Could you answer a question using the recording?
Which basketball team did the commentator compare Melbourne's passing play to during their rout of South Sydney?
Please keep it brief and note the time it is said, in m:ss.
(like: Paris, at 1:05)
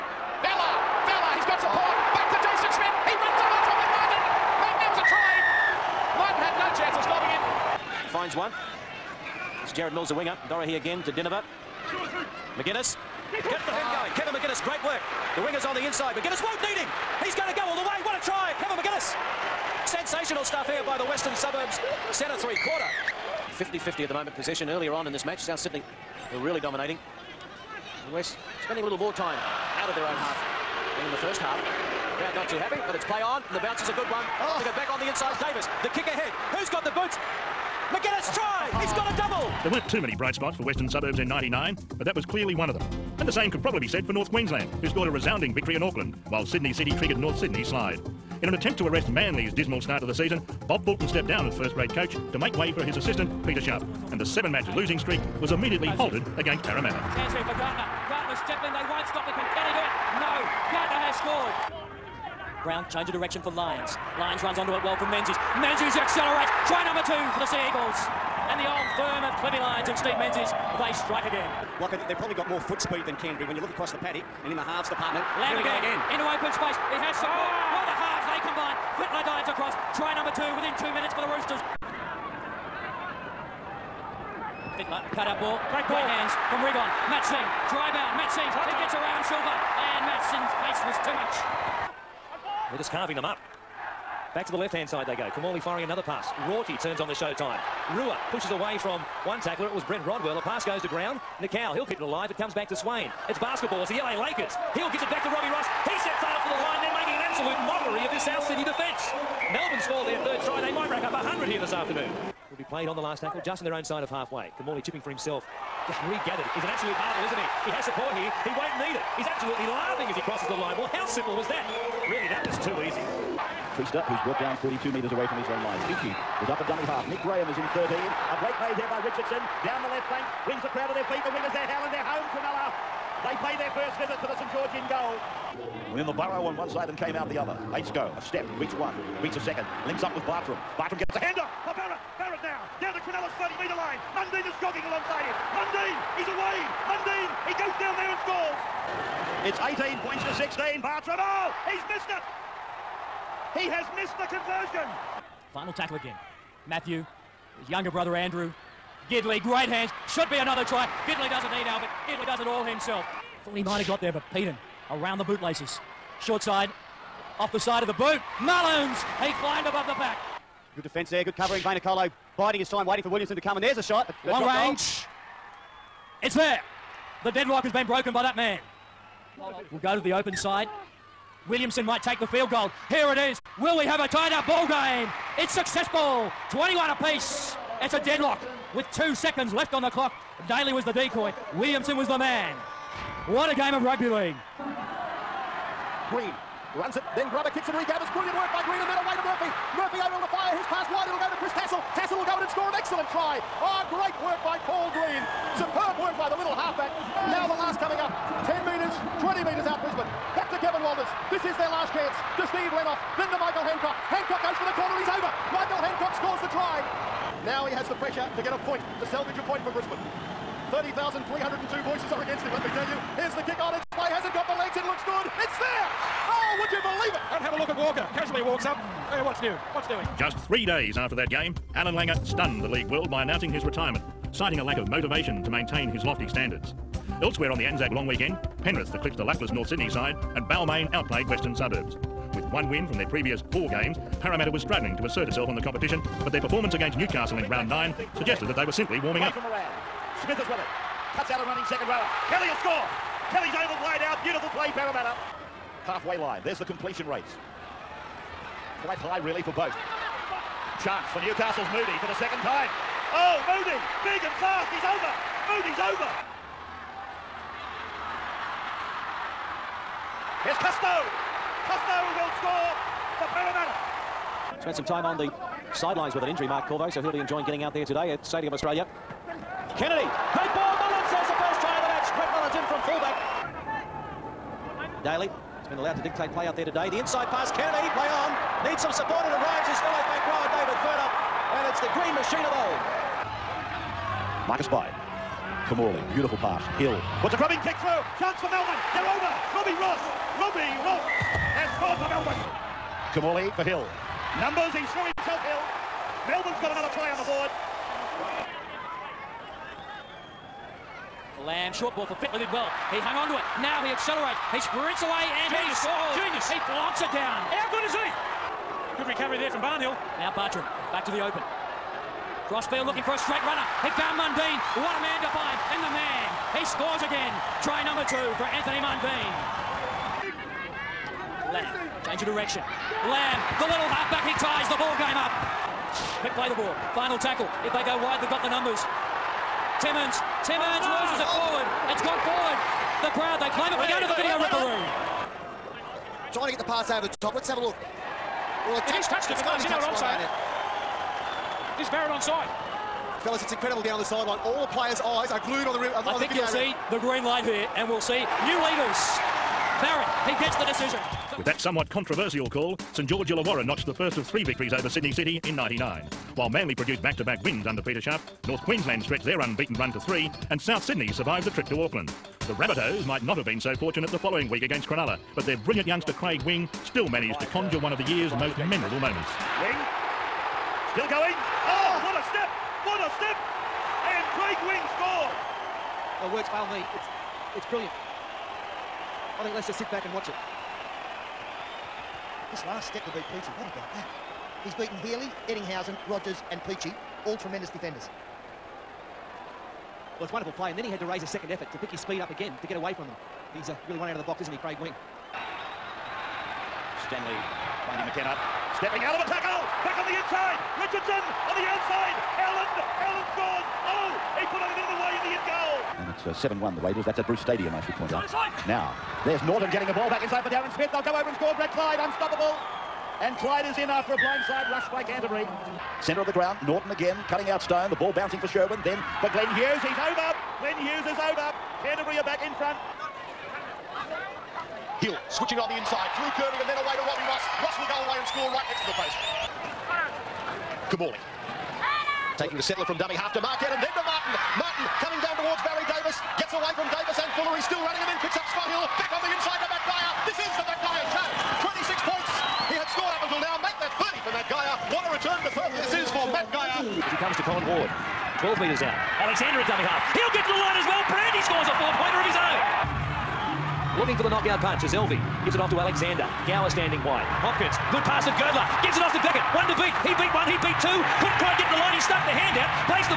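LA Lakers, at 1:43.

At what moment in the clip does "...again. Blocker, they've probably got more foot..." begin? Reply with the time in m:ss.
1:11.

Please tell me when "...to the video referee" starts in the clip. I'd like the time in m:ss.
5:44.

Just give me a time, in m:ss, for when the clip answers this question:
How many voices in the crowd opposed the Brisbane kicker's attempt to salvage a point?
3:40.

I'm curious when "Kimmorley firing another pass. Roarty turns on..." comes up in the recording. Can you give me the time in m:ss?
1:35.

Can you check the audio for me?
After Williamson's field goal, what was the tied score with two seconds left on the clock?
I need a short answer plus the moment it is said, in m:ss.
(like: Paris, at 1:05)
21 apiece, at 3:06.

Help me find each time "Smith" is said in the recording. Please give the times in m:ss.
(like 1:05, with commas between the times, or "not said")
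0:02, 4:10, 7:00.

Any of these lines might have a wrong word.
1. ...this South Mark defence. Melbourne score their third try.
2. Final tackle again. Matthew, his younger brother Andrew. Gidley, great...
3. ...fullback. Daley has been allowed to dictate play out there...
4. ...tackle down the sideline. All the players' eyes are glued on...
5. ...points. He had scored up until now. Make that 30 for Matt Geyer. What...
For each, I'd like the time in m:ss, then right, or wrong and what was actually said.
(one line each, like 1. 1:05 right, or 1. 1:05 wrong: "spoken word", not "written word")
1. 1:48 wrong: "Sydney", not "Mark"
2. 2:35 right
3. 4:44 right
4. 5:53 wrong: "incredible", not "tackle"
5. 7:32 right.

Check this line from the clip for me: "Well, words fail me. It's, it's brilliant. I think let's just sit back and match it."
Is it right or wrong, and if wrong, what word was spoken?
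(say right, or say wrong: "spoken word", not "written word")
wrong: "watch", not "match".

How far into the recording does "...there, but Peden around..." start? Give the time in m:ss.
2:44.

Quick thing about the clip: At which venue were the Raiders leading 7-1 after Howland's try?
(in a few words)
Bruce Stadium.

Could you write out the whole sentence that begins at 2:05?
Peachey is up a dummy half.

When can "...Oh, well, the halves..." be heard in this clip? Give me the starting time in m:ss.
1:17.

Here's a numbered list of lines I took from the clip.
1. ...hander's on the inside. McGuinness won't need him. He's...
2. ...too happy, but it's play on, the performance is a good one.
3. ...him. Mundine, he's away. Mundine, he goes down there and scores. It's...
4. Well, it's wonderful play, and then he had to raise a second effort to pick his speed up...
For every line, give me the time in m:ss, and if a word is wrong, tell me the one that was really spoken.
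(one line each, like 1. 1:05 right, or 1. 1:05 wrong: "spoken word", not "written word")
1. 0:15 wrong: "winger", not "hander"
2. 0:32 wrong: "bounce", not "performance"
3. 2:25 right
4. 6:40 right.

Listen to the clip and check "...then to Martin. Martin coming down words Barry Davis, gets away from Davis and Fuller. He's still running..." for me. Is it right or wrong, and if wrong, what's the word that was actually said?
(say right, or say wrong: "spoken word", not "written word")
wrong: "towards", not "words".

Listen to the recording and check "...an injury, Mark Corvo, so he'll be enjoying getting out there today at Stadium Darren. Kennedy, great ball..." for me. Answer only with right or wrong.
wrong.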